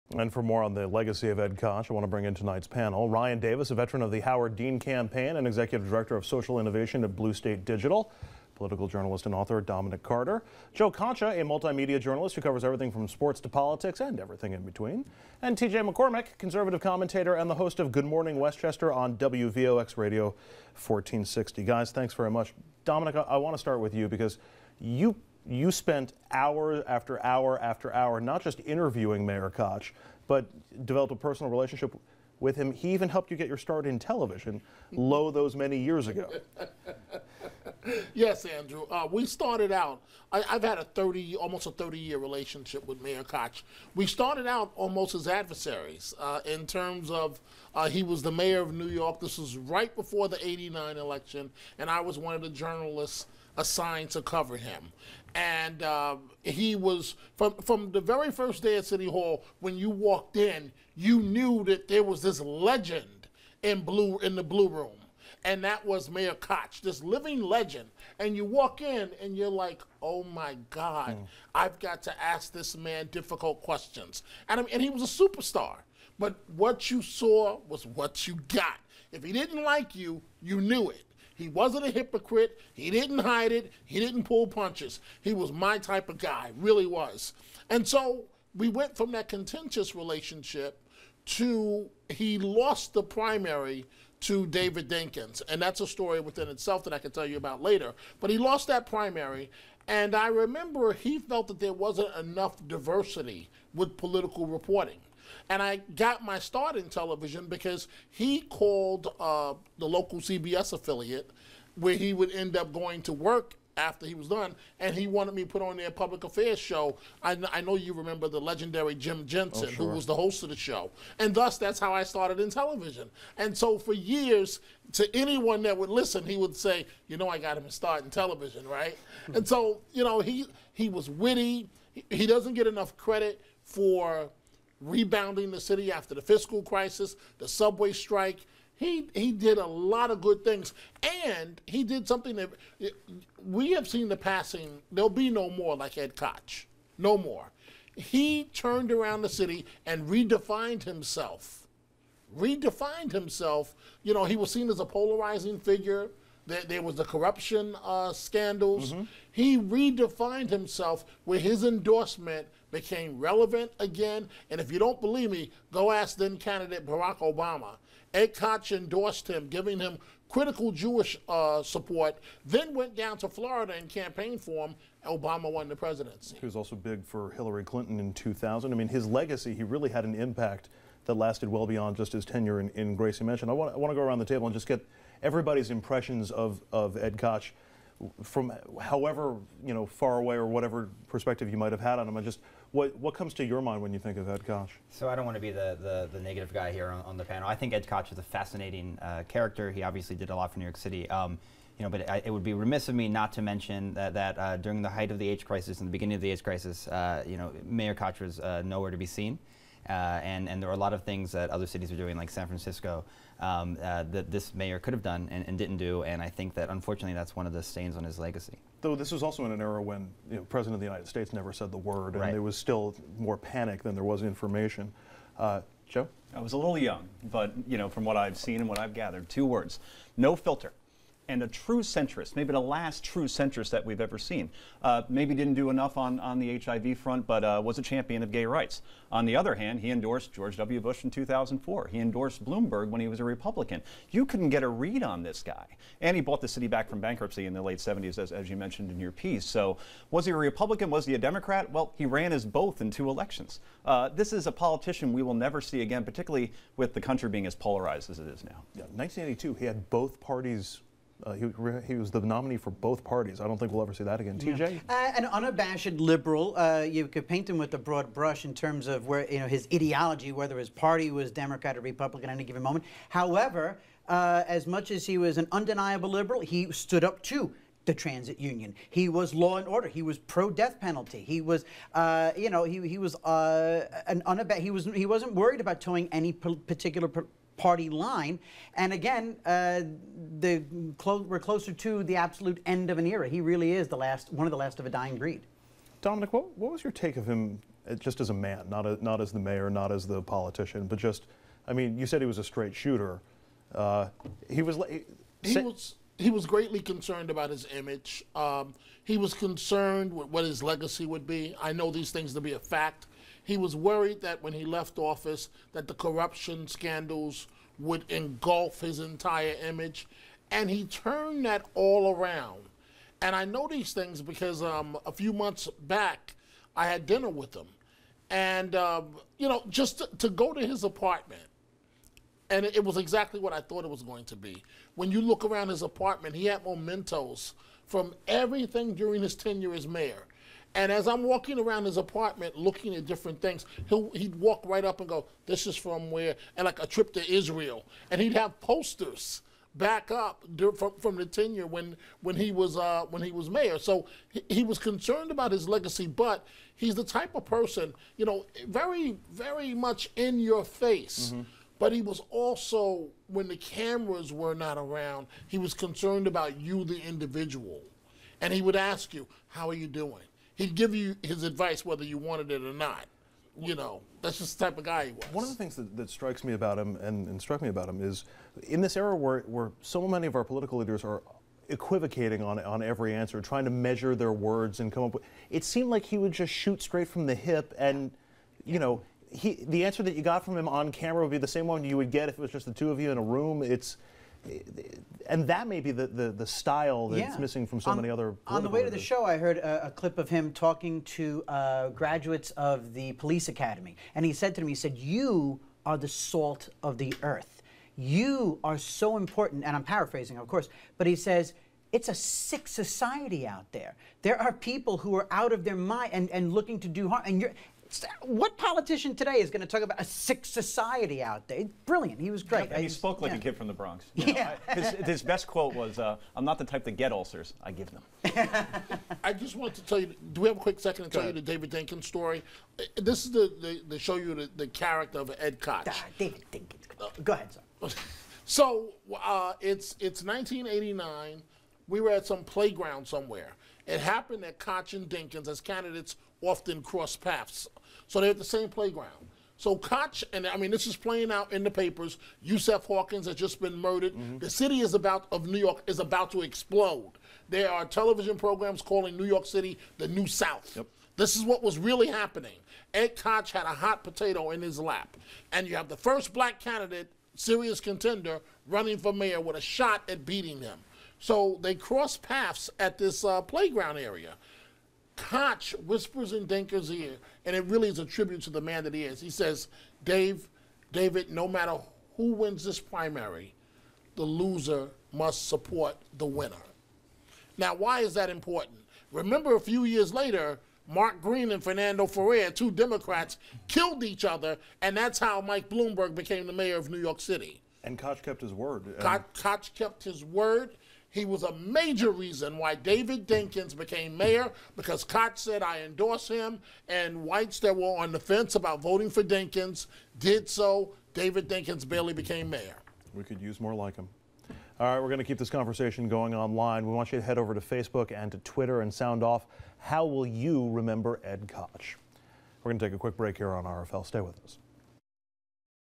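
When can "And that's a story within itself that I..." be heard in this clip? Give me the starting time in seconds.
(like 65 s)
95 s.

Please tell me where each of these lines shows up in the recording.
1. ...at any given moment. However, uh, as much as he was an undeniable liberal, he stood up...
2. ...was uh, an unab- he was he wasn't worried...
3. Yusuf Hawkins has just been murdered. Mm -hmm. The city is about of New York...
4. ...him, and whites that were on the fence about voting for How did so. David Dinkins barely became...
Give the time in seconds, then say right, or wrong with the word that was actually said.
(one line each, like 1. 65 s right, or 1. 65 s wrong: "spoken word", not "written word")
1. 272 s right
2. 282 s right
3. 452 s right
4. 506 s wrong: "Dinkins", not "How".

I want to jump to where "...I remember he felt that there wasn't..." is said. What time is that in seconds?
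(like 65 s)
100 s.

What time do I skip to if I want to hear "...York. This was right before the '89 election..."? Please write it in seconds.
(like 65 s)
48 s.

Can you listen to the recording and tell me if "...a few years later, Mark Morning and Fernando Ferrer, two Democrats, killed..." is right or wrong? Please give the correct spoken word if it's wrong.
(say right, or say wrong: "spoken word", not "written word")
wrong: "Green", not "Morning".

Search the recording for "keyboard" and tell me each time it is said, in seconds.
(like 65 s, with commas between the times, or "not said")
not said.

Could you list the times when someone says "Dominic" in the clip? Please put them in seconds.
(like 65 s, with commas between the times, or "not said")
9 s, 22 s, 296 s.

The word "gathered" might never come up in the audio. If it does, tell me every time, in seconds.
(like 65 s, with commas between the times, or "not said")
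228 s.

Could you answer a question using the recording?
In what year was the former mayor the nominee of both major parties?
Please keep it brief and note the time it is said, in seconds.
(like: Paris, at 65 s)
1982, at 258 s.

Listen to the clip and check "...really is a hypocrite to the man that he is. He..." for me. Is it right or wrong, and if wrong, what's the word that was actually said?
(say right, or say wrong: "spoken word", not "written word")
wrong: "tribute", not "hypocrite".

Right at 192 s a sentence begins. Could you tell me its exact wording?
I just what, what comes to your mind when you think of Ed Koch?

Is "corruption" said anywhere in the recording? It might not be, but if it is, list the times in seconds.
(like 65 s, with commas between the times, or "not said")
157 s, 315 s.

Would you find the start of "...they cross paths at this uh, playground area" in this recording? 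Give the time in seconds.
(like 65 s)
471 s.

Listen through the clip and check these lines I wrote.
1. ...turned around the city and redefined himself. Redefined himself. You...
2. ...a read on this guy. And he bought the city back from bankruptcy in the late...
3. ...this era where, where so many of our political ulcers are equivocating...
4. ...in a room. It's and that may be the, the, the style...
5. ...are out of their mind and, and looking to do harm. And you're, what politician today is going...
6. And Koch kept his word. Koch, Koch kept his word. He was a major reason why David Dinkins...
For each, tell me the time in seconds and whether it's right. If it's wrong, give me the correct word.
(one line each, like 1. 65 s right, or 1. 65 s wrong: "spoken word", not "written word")
1. 148 s right
2. 244 s right
3. 378 s wrong: "leaders", not "ulcers"
4. 393 s right
5. 415 s right
6. 497 s right.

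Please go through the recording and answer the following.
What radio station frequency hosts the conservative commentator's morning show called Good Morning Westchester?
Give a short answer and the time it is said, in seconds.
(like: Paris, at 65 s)
WVOX Radio 1460, at 19 s.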